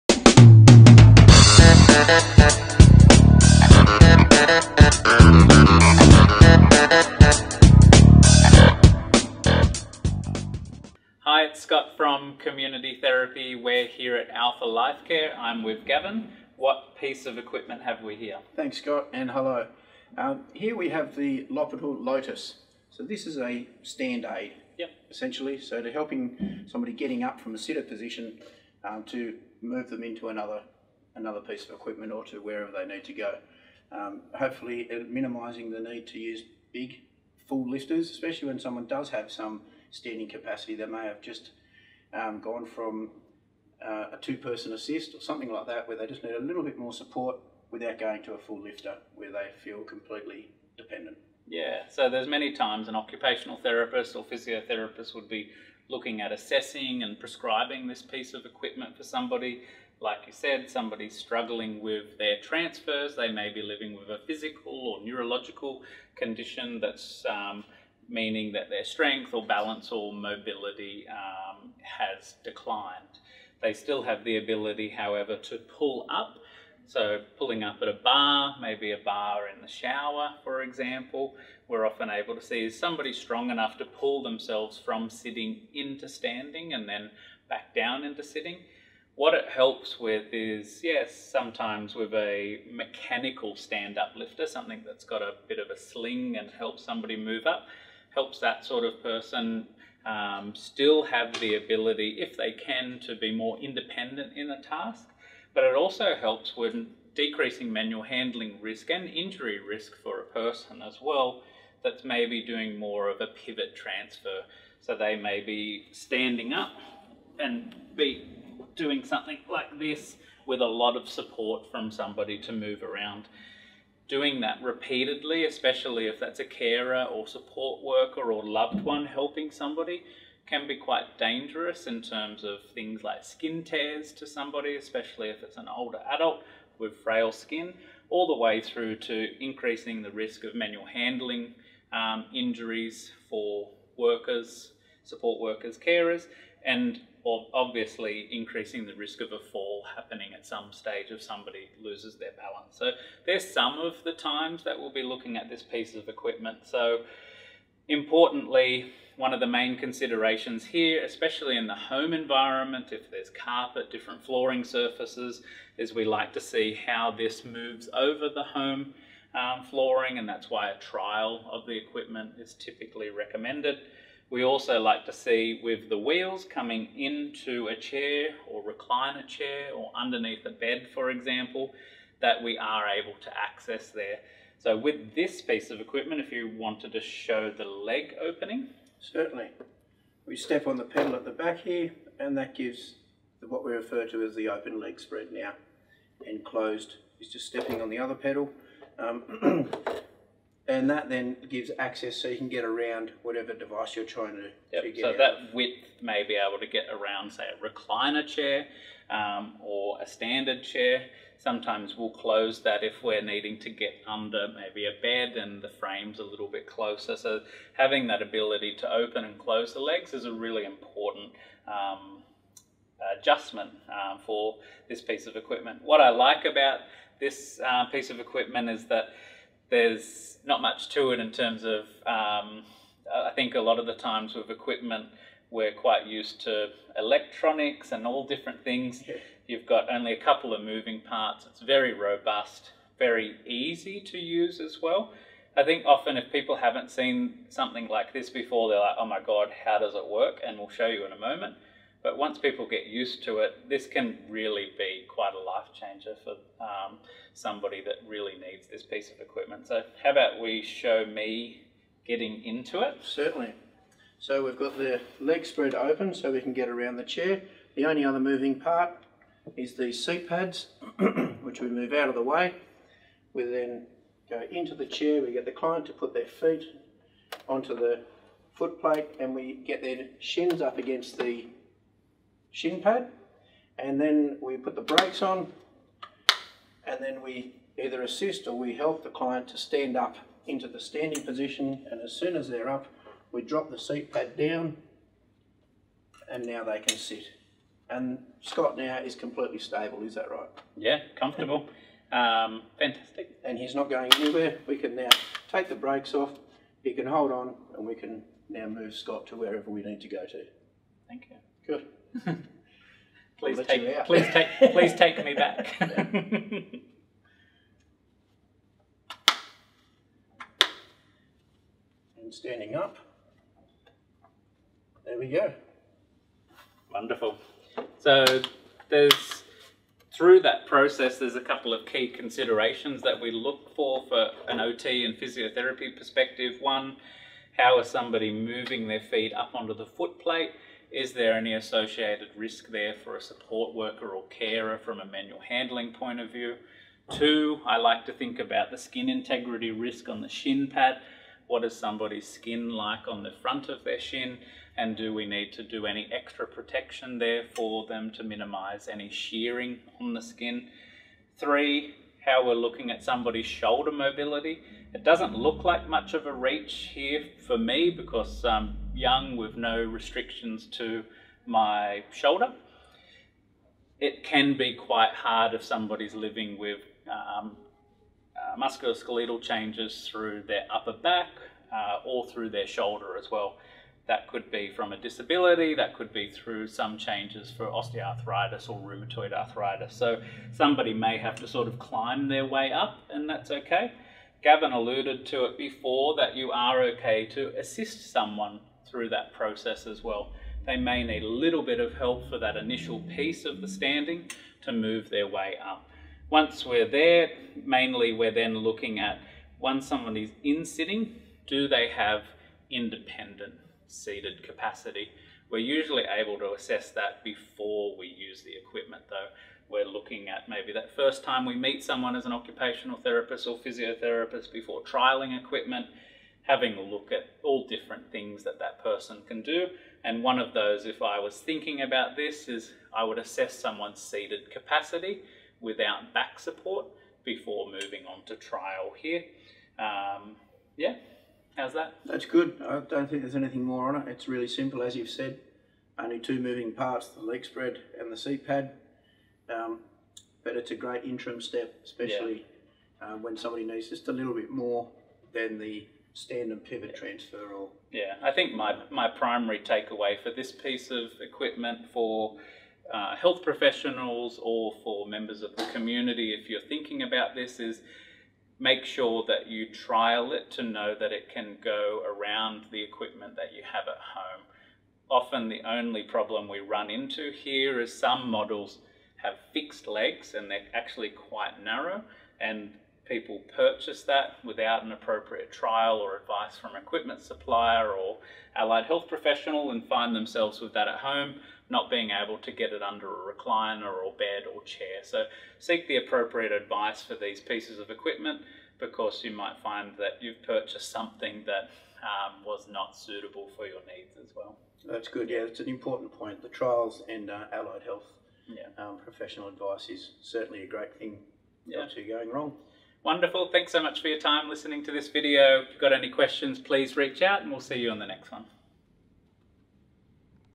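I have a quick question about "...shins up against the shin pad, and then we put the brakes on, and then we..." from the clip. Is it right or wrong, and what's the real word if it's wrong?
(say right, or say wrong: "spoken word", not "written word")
right.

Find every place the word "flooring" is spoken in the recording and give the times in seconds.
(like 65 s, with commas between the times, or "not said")
164 s, 169 s.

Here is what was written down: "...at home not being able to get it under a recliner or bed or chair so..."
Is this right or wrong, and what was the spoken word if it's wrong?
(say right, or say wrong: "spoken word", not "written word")
right.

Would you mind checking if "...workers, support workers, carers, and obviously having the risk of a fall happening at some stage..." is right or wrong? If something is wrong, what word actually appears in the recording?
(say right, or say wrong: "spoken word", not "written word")
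wrong: "increasing", not "having".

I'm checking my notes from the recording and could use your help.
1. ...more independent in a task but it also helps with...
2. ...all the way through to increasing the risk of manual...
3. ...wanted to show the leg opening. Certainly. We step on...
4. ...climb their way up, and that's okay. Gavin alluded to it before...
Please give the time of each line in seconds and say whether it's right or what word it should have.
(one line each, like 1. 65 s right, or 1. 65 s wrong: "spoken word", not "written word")
1. 103 s right
2. 138 s right
3. 186 s right
4. 391 s right.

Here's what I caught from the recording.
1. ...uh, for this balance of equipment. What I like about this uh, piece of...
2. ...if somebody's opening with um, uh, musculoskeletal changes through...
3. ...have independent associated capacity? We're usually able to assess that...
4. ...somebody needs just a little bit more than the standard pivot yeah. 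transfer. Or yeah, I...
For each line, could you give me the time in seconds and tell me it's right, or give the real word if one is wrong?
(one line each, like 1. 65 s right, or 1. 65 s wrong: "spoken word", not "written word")
1. 223 s wrong: "piece", not "balance"
2. 375 s wrong: "living", not "opening"
3. 411 s wrong: "seated", not "associated"
4. 453 s right.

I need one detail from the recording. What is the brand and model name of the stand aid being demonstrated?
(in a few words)
Lopital Lotus.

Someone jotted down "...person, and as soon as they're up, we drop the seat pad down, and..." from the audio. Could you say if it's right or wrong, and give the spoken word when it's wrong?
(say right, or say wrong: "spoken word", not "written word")
wrong: "position", not "person".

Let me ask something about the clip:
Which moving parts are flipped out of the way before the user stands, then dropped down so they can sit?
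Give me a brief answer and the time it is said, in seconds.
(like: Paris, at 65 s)
Seat pads, at 270 s.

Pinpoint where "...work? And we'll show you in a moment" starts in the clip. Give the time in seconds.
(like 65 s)
250 s.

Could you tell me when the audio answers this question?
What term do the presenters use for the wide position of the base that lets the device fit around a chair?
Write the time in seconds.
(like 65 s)
194 s.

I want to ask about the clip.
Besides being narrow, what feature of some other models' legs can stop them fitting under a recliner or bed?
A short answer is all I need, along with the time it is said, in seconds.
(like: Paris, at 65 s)
Fixed legs, at 479 s.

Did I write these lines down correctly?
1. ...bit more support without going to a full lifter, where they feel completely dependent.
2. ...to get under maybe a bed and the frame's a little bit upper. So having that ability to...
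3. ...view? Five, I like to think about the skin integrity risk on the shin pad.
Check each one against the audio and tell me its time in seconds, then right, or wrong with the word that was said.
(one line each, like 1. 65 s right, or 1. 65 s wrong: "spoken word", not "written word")
1. 46 s right
2. 213 s wrong: "closer", not "upper"
3. 346 s wrong: "Two", not "Five".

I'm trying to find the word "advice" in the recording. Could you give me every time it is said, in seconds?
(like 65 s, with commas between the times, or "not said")
486 s, 496 s, 509 s.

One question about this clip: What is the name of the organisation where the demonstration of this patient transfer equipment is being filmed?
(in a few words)
Alpha Life Care.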